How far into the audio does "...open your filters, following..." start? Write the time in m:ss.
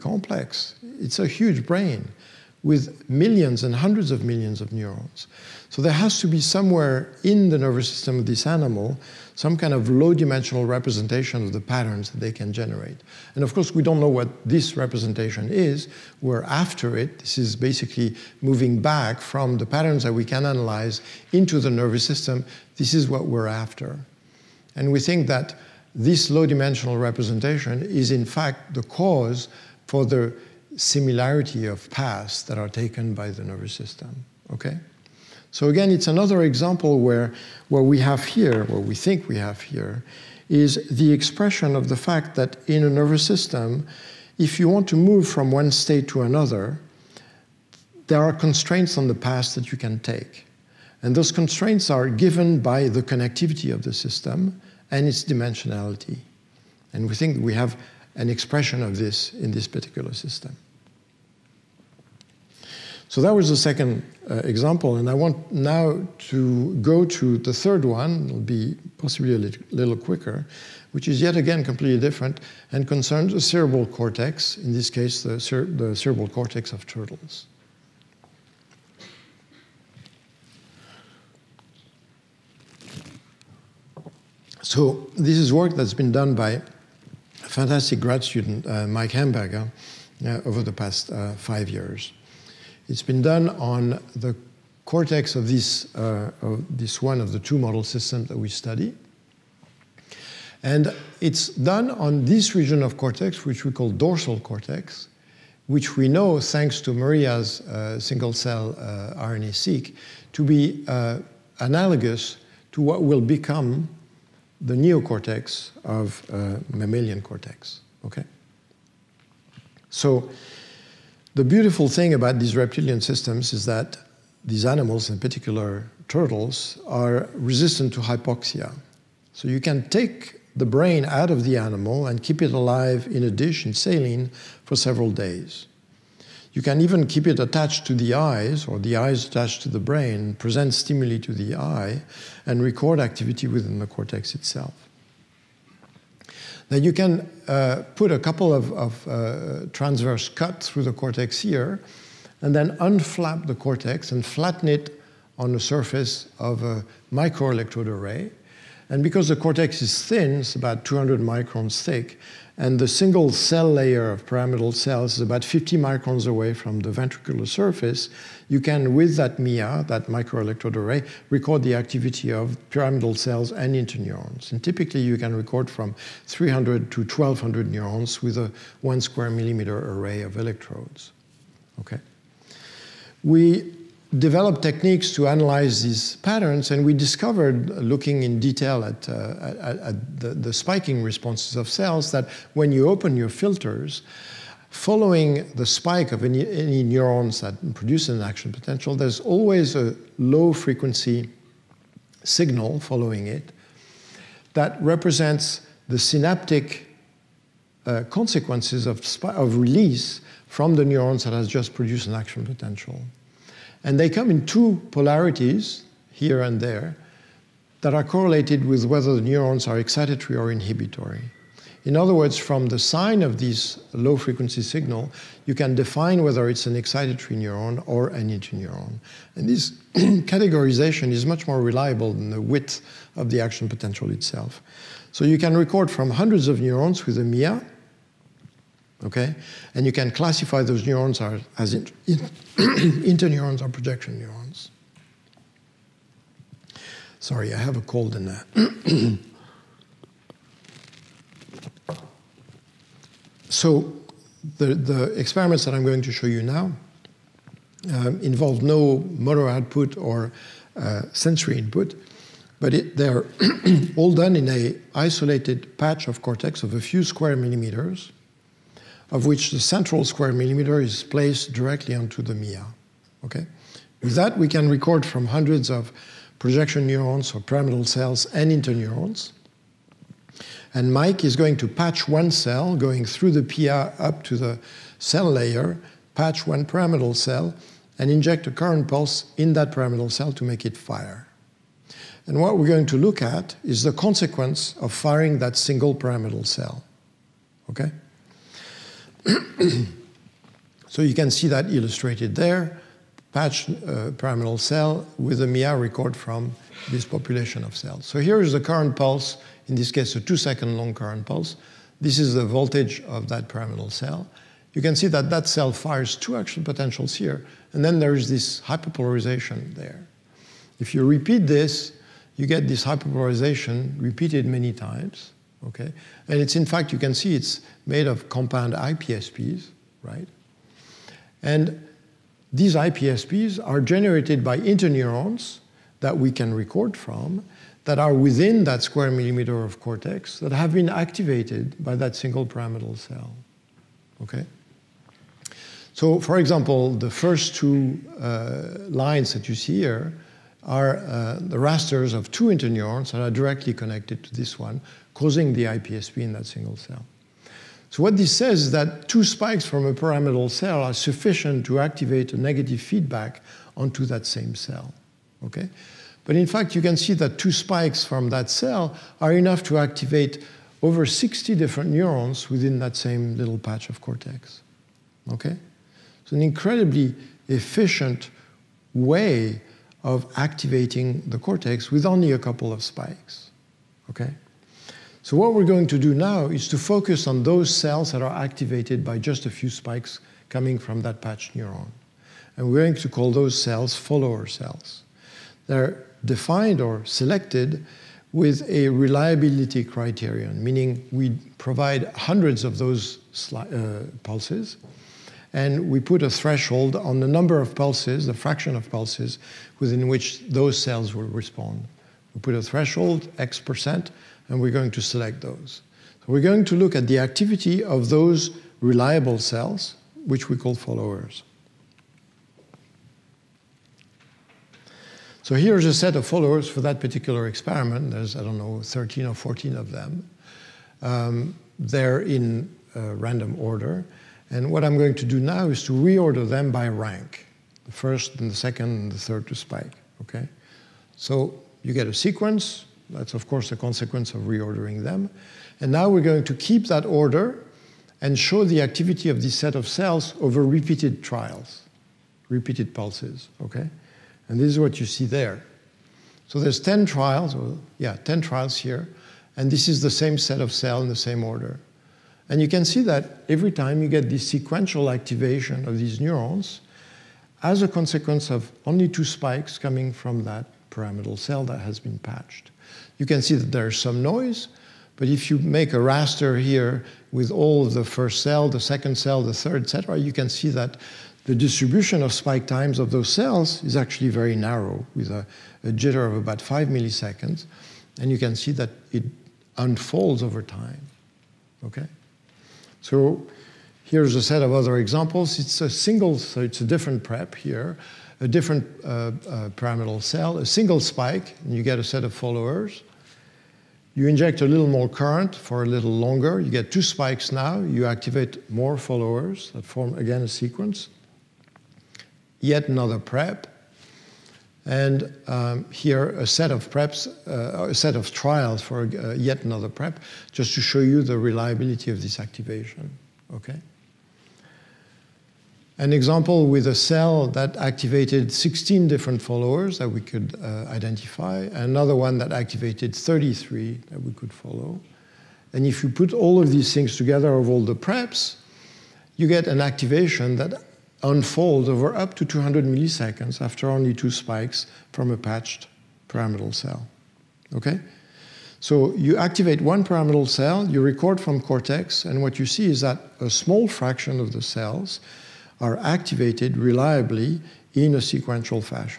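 3:12.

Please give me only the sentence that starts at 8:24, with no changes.
You inject a little more current for a little longer.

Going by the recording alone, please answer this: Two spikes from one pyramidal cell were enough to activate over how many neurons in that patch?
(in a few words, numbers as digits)
60.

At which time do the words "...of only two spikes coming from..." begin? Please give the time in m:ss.
7:48.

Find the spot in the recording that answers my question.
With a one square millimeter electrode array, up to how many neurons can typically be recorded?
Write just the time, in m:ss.
2:56.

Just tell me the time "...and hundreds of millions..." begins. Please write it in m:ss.
0:03.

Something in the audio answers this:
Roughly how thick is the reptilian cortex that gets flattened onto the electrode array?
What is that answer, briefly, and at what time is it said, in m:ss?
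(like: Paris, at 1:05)
200 microns, at 2:40.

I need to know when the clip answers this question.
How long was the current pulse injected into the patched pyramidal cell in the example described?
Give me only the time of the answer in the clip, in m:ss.
5:10.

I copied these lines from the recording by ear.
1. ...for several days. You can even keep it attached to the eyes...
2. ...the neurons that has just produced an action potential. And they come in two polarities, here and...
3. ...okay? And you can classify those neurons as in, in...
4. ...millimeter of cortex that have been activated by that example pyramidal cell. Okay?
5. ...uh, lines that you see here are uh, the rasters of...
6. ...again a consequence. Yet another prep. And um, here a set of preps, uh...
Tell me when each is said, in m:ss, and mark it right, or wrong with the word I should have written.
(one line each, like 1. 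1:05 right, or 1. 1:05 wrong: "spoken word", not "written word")
1. 2:14 right
2. 3:30 right
3. 3:59 right
4. 5:39 wrong: "single", not "example"
5. 5:48 right
6. 8:30 wrong: "sequence", not "consequence".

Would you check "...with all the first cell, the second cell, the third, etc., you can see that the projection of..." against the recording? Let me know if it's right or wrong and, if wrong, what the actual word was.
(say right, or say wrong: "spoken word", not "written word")
wrong: "distribution", not "projection".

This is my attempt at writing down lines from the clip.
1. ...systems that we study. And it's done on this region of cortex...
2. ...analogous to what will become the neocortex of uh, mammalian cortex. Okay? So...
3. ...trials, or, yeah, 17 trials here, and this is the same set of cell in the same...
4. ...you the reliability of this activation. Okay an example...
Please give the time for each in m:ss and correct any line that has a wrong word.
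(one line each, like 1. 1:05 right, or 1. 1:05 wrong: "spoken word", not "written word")
1. 1:37 right
2. 1:51 right
3. 7:37 wrong: "10", not "17"
4. 8:40 right.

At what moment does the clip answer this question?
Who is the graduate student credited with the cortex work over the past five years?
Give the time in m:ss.
1:28.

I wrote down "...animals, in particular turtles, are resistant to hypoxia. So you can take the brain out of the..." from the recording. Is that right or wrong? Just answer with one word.
right.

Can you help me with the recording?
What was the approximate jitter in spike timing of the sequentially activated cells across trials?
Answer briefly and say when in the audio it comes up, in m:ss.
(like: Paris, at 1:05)
5 milliseconds, at 8:06.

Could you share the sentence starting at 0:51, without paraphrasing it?
And those constraints are given by the connectivity of the system and its dimensionality.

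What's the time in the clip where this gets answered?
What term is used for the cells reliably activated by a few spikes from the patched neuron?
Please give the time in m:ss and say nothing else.
6:33.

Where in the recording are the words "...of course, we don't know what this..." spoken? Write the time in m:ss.
0:13.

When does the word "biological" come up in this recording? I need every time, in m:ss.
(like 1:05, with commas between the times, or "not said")
not said.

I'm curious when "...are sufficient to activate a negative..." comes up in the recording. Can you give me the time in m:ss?
6:00.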